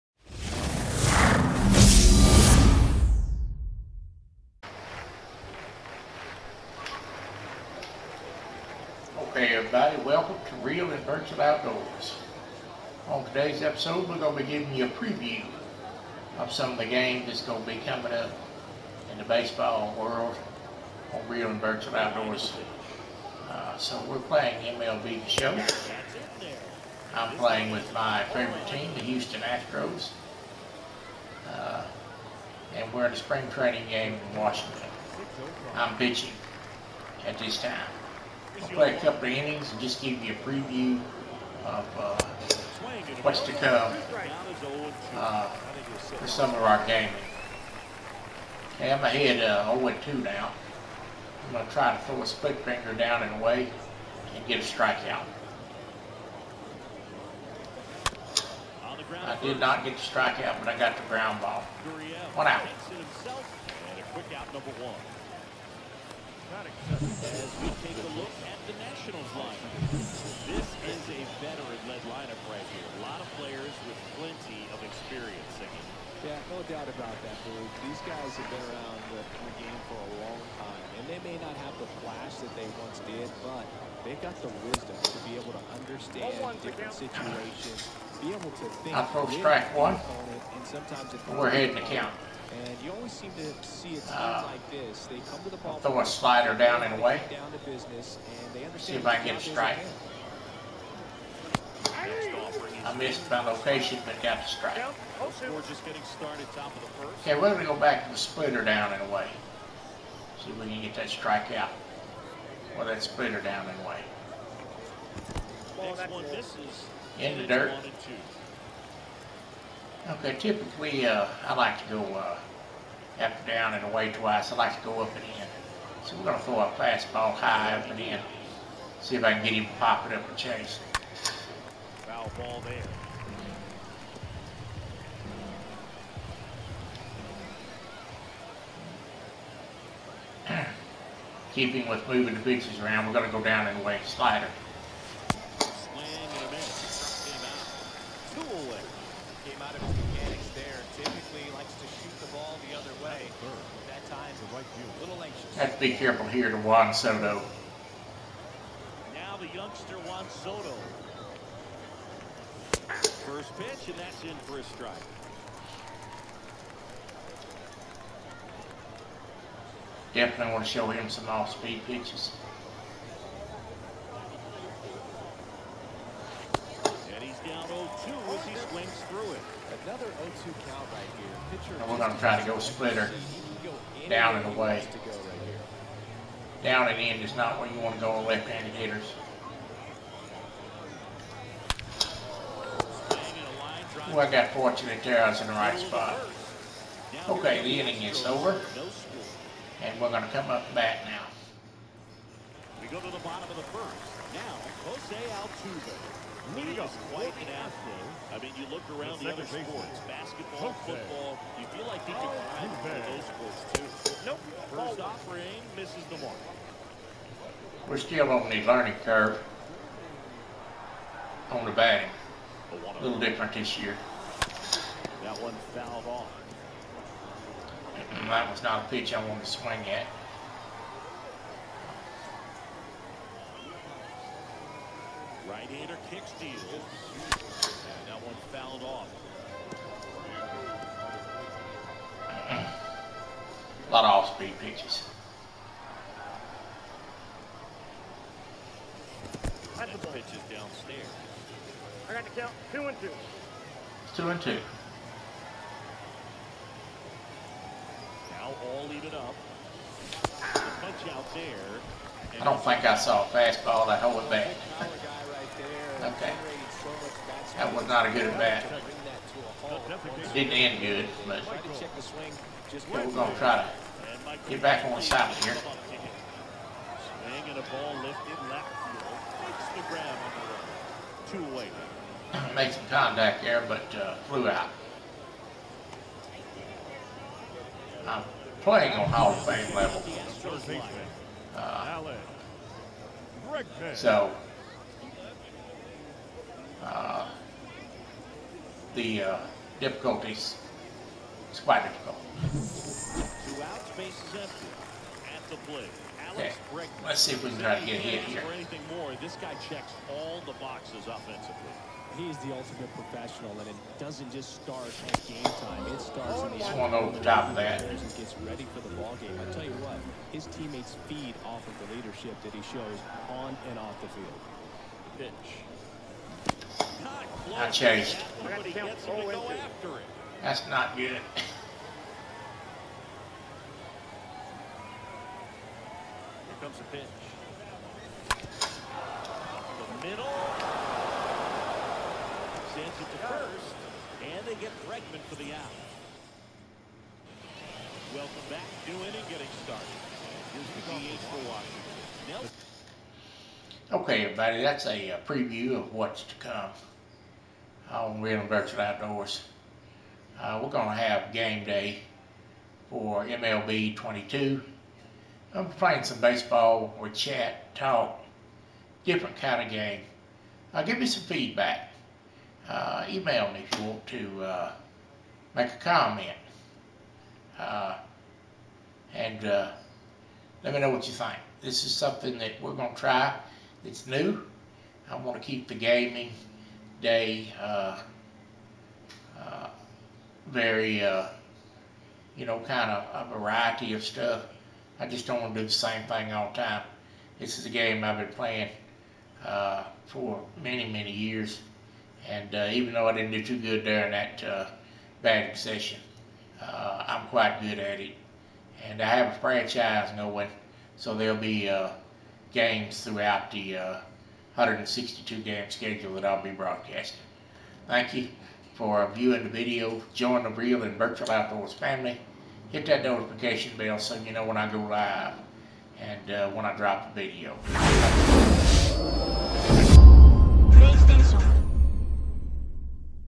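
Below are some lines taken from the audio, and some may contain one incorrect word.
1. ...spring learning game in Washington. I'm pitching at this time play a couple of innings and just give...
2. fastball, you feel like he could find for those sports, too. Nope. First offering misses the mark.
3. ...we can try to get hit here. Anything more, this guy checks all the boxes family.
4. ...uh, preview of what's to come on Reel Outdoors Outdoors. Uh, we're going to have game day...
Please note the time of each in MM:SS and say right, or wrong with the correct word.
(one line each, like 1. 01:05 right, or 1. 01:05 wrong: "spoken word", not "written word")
1. 00:33 wrong: "training", not "learning"
2. 03:30 wrong: "football", not "fastball"
3. 05:07 wrong: "offensively", not "family"
4. 05:55 wrong: "Virtual", not "Outdoors".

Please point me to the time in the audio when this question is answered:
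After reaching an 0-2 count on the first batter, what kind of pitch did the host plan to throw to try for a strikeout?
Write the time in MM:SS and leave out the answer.
00:52.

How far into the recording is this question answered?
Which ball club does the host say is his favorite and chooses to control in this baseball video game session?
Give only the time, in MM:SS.
00:29.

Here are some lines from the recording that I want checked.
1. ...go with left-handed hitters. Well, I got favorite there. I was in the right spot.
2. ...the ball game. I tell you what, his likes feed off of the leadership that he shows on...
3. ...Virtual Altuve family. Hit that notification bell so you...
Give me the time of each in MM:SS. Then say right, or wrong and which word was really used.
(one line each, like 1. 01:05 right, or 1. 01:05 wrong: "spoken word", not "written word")
1. 03:08 wrong: "fortunate", not "favorite"
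2. 05:18 wrong: "teammates", not "likes"
3. 07:00 wrong: "Outdoors", not "Altuve".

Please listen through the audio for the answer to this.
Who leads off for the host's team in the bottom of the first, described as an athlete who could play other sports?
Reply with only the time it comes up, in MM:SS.
03:24.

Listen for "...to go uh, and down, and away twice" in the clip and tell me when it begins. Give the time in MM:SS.
02:01.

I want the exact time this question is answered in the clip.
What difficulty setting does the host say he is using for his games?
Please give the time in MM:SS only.
04:49.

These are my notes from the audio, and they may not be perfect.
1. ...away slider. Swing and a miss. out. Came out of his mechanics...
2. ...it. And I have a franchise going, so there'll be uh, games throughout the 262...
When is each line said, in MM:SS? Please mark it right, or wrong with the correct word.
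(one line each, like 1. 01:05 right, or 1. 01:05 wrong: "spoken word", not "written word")
1. 02:23 right
2. 06:47 wrong: "162", not "262".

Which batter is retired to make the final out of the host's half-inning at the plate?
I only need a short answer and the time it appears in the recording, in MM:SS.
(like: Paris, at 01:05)
Bregman, at 05:44.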